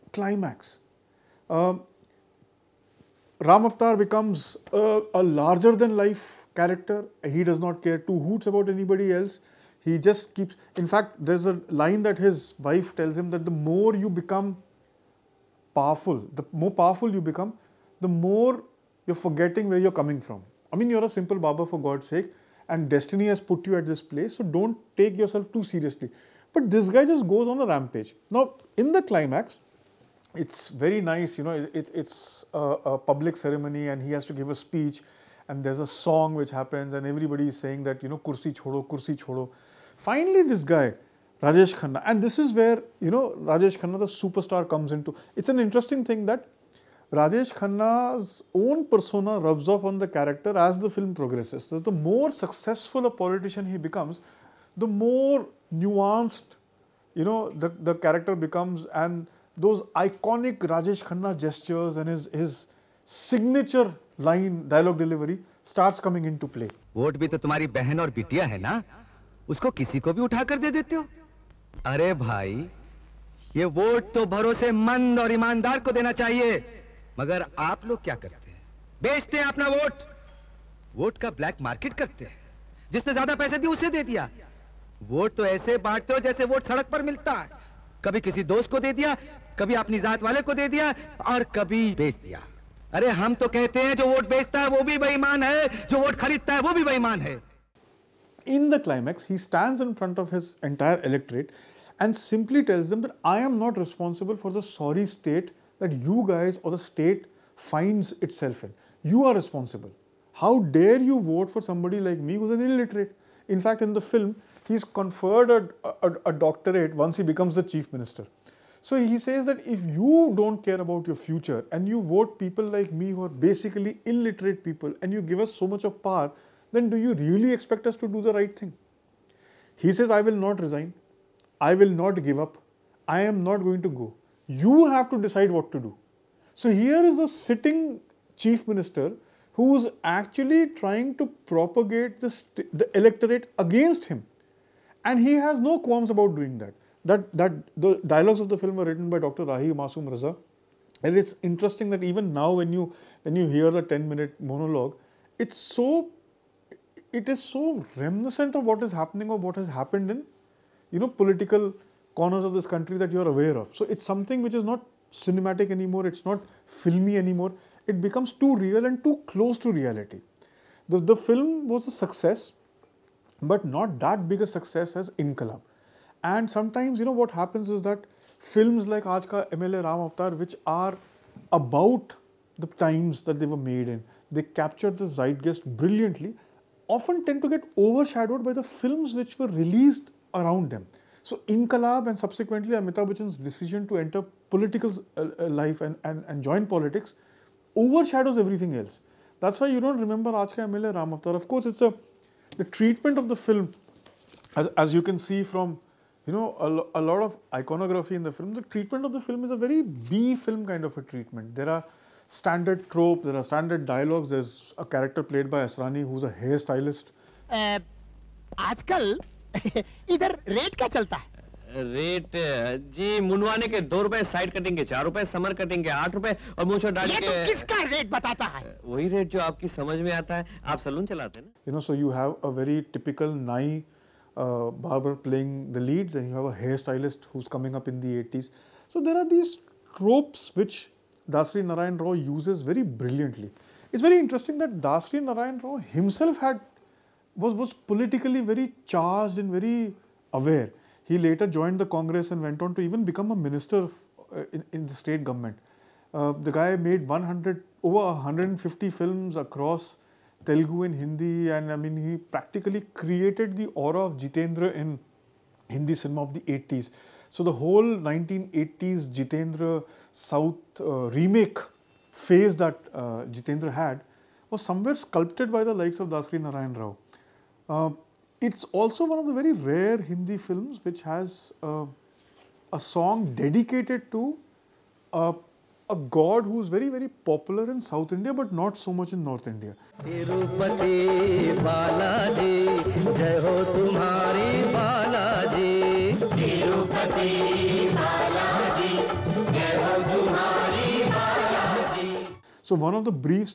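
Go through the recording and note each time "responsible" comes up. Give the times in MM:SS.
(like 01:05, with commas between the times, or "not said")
01:43, 01:49.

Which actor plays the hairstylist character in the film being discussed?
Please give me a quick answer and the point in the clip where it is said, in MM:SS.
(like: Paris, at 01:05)
Asrani, at 03:35.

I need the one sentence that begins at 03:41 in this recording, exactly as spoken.
रेट uh, uh, जी मुनवाने के दो रुपए साइड कटिंग के चार रुपए समर कटिंग के आठ रुपए और मूछों डाल के.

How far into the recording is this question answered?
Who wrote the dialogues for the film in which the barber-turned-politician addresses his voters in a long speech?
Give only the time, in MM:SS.
02:29.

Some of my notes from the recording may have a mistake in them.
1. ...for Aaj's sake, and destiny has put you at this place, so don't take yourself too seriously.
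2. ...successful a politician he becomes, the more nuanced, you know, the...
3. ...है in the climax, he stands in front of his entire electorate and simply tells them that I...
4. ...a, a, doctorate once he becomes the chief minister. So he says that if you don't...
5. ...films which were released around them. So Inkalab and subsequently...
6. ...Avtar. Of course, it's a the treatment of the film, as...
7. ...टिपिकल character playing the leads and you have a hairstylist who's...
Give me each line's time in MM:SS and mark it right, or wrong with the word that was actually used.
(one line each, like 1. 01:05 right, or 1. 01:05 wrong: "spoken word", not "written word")
1. 00:21 wrong: "God", not "Aaj"
2. 00:52 right
3. 01:37 right
4. 01:56 right
5. 03:08 right
6. 03:21 right
7. 03:52 wrong: "barber", not "character".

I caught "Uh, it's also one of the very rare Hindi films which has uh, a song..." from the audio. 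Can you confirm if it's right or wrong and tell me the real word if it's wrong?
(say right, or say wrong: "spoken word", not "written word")
right.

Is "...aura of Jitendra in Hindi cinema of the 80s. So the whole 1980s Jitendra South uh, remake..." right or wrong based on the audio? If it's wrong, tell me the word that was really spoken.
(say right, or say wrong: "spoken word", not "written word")
right.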